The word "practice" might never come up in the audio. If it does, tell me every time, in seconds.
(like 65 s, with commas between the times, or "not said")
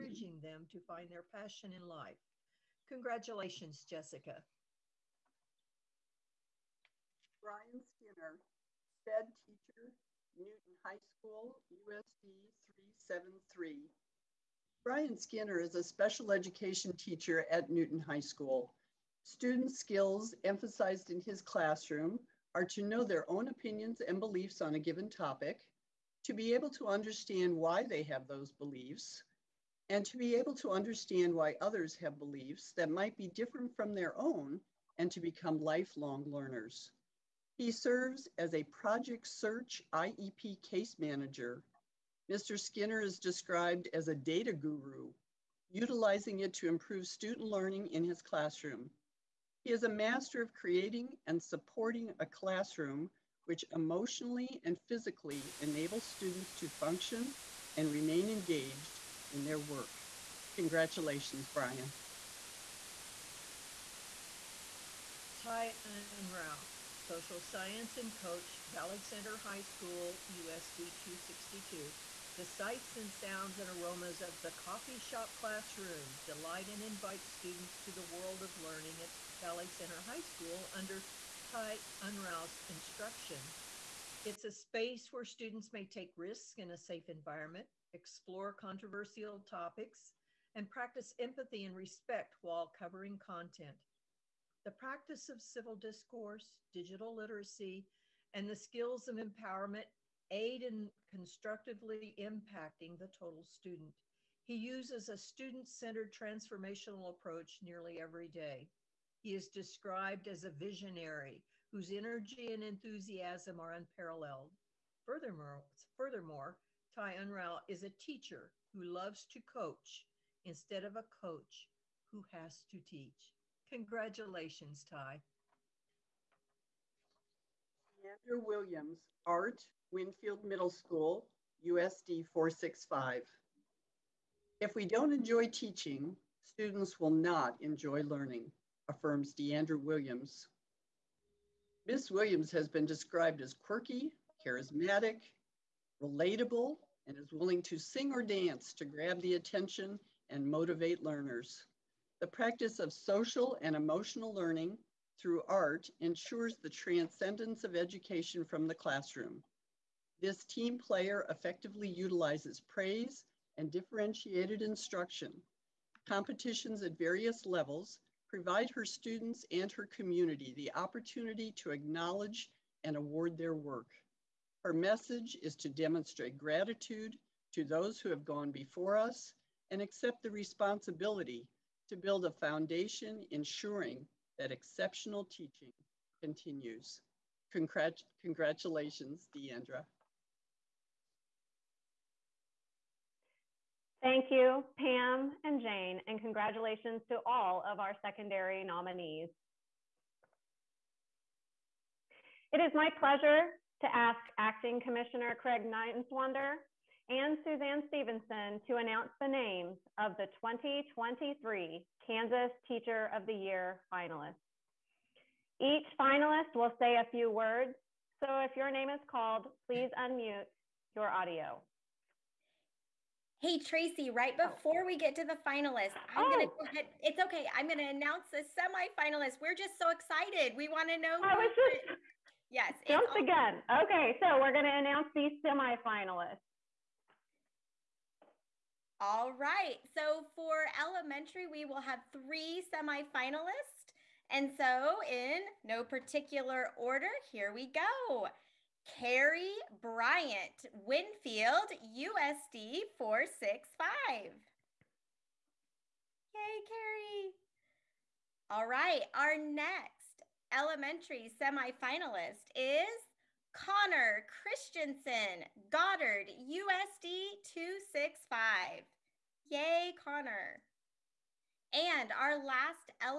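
90 s, 94 s, 152 s.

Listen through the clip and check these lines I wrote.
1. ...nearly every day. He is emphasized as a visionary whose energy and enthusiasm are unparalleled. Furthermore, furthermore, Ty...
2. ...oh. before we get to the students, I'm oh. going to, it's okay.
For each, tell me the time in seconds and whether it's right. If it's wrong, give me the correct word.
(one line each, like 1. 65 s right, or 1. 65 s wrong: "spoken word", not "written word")
1. 107 s wrong: "described", not "emphasized"
2. 224 s wrong: "finalists", not "students".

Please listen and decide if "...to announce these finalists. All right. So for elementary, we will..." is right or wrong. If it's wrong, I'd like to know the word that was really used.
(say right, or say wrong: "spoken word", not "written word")
wrong: "semifinalists", not "finalists".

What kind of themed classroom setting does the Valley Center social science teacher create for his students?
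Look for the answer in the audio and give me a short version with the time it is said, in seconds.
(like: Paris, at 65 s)
coffee shop, at 74 s.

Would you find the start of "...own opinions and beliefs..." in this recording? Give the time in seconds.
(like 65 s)
23 s.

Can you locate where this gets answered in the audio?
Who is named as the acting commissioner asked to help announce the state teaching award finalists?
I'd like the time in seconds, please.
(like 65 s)
205 s.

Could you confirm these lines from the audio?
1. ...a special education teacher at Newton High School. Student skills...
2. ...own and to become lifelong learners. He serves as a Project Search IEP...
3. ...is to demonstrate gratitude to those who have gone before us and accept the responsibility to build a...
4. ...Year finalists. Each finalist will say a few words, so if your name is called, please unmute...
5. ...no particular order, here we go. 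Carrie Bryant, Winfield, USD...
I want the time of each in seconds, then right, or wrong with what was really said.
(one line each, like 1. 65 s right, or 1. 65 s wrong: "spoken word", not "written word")
1. 15 s right
2. 34 s right
3. 175 s right
4. 213 s right
5. 245 s right.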